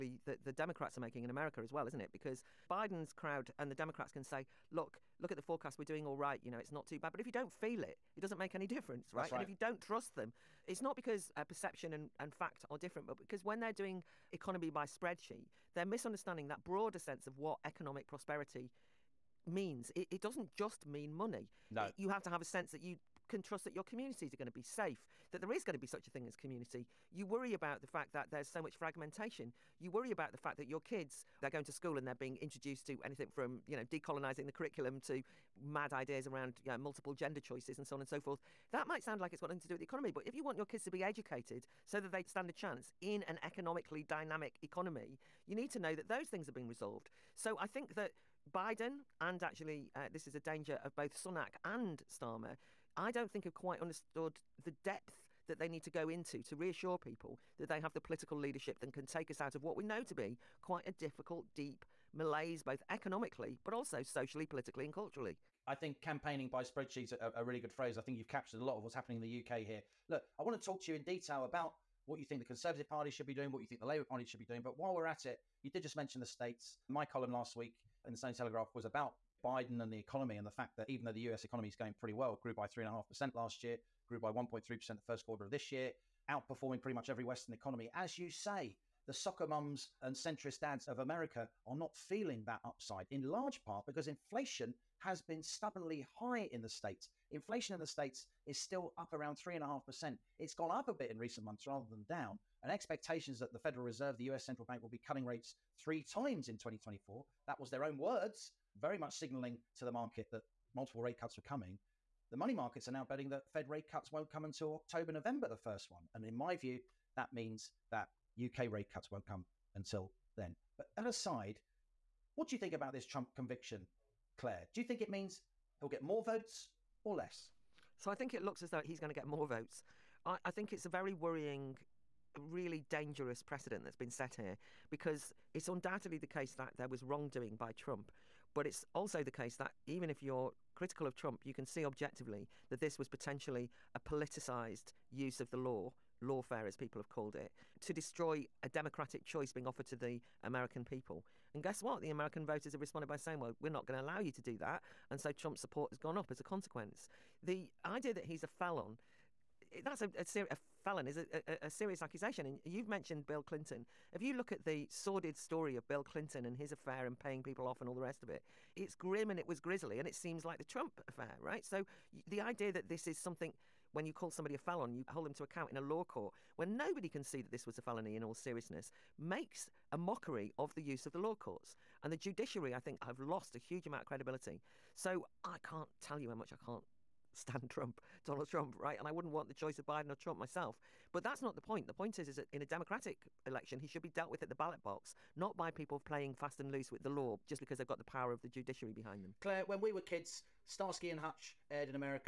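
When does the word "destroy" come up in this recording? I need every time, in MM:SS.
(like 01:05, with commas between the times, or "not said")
02:27.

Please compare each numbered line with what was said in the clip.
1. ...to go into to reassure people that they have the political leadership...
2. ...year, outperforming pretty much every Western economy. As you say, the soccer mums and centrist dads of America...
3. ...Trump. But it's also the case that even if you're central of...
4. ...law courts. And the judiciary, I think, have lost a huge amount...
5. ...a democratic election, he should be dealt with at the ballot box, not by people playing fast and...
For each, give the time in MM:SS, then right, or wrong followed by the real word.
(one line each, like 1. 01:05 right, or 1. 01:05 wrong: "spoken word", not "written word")
1. 00:55 right
2. 01:25 right
3. 02:17 wrong: "critical", not "central"
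4. 03:01 right
5. 03:12 right.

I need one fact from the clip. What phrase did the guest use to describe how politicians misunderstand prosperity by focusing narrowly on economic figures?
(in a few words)
economy by spreadsheet.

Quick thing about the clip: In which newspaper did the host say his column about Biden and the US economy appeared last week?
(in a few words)
Sunday Telegraph.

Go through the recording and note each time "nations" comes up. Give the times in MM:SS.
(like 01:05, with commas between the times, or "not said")
not said.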